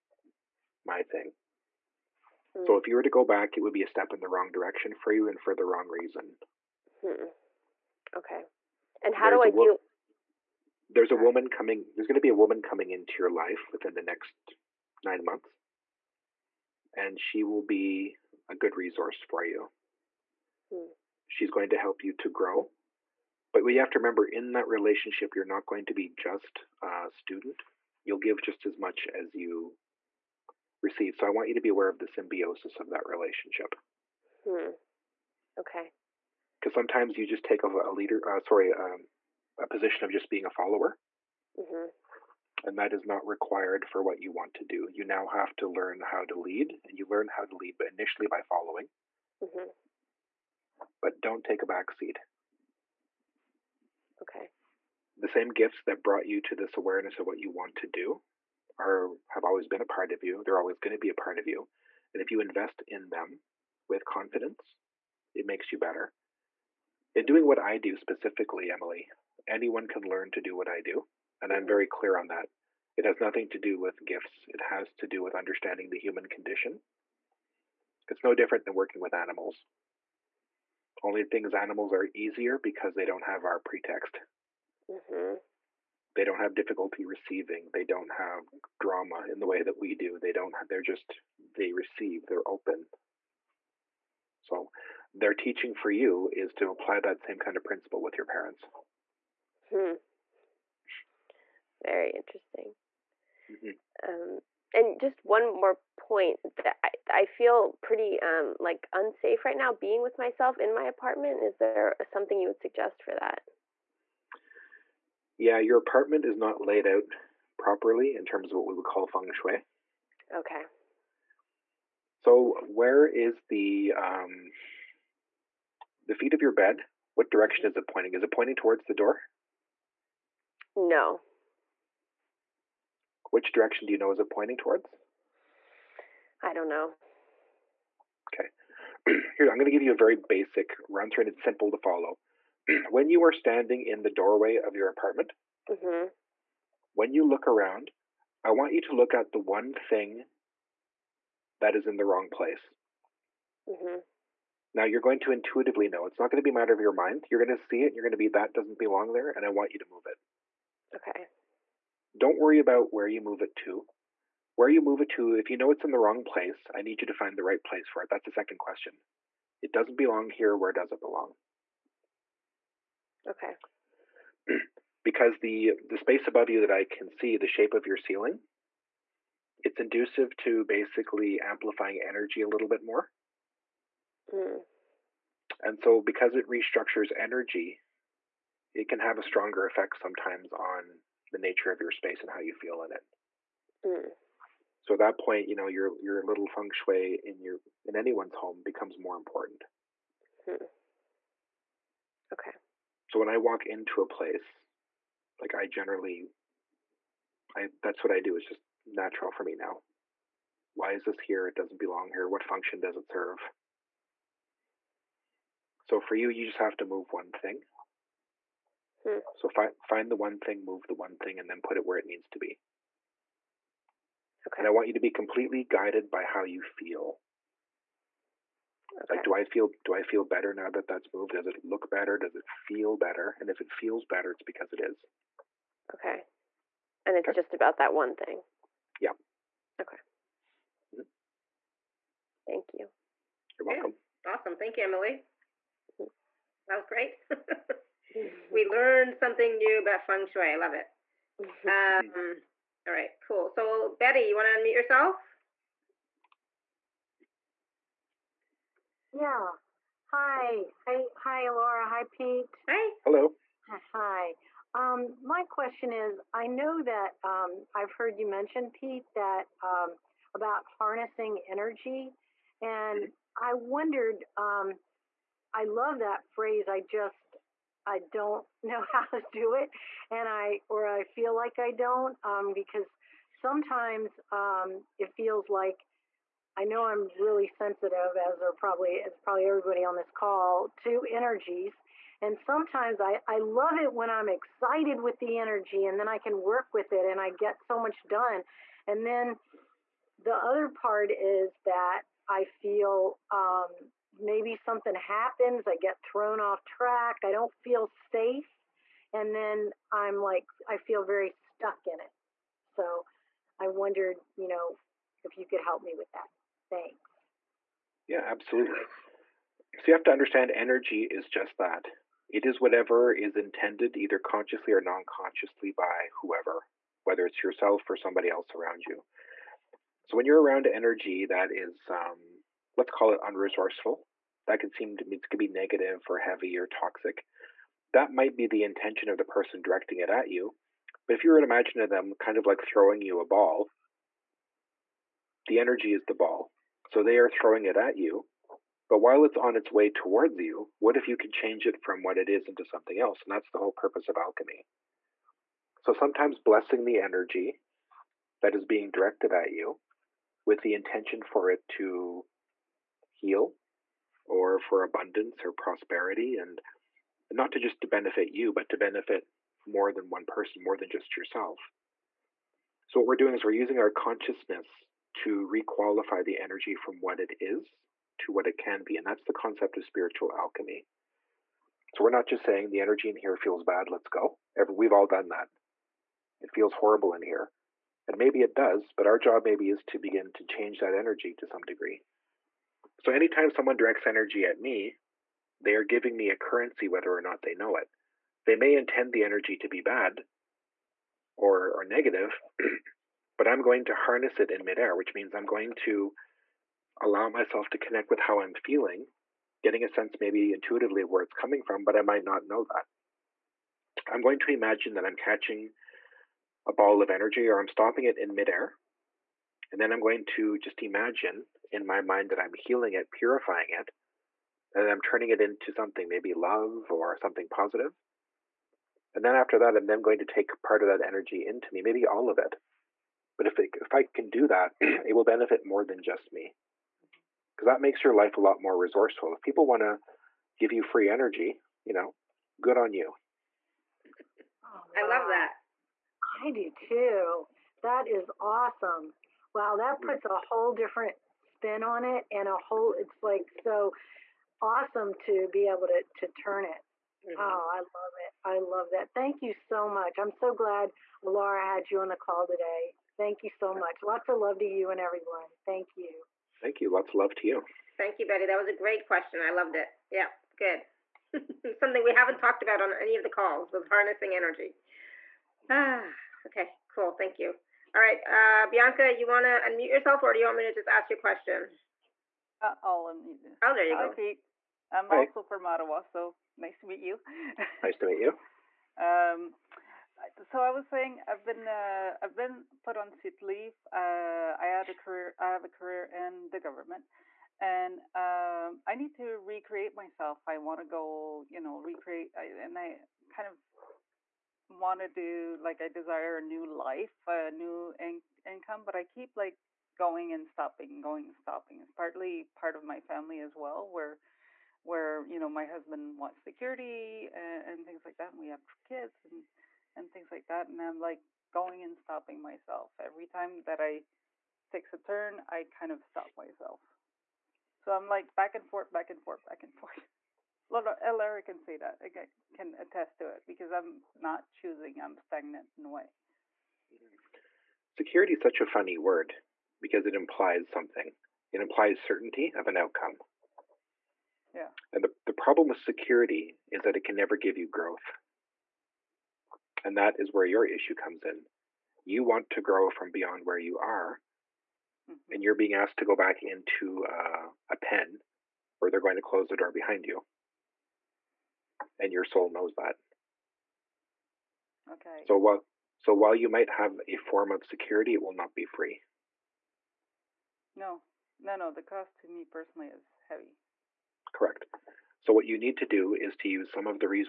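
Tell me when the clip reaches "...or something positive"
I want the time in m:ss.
7:06.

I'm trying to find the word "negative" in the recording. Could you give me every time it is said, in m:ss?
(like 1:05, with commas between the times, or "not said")
5:35, 6:41.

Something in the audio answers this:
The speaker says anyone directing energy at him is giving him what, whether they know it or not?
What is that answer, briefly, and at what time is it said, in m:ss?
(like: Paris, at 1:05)
currency, at 6:36.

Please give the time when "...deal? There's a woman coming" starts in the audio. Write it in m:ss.
0:09.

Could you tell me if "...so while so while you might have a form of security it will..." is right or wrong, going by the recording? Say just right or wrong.
right.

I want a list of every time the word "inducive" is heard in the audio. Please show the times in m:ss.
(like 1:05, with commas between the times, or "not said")
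2:59.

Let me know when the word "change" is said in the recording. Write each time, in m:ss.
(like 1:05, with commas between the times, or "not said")
5:51, 6:30.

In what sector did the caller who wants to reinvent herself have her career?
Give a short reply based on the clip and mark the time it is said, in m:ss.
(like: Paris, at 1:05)
government, at 8:16.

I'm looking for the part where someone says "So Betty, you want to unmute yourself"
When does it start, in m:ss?
4:13.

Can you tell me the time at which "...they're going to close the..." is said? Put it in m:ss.
9:18.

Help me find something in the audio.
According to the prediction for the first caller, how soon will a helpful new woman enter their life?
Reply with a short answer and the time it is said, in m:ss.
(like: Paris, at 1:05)
9 months, at 0:15.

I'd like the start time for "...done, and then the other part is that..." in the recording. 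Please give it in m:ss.
4:58.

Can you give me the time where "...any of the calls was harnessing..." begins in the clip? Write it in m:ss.
7:52.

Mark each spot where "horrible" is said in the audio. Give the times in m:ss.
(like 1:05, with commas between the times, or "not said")
6:26.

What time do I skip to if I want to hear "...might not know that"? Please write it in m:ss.
6:52.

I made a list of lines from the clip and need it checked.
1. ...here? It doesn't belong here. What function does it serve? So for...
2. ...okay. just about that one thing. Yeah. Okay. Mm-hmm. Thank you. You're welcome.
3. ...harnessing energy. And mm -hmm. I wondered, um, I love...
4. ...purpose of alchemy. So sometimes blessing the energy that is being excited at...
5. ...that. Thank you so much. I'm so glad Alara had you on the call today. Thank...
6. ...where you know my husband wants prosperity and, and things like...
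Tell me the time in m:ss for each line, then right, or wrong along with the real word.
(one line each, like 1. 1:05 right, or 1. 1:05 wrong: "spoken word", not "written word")
1. 3:31 right
2. 3:57 right
3. 4:30 right
4. 5:53 wrong: "directed", not "excited"
5. 7:38 right
6. 8:34 wrong: "security", not "prosperity".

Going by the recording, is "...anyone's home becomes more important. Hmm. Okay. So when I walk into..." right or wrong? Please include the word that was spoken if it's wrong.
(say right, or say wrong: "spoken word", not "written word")
right.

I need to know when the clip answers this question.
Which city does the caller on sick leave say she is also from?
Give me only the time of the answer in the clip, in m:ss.
8:05.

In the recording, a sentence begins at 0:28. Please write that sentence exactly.
You'll give just as much as you receive.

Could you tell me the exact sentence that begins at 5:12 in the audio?
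So I wondered, you know, if you could help me with that.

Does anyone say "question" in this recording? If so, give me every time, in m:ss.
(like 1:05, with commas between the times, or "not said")
2:48, 4:25, 7:49, 8:01.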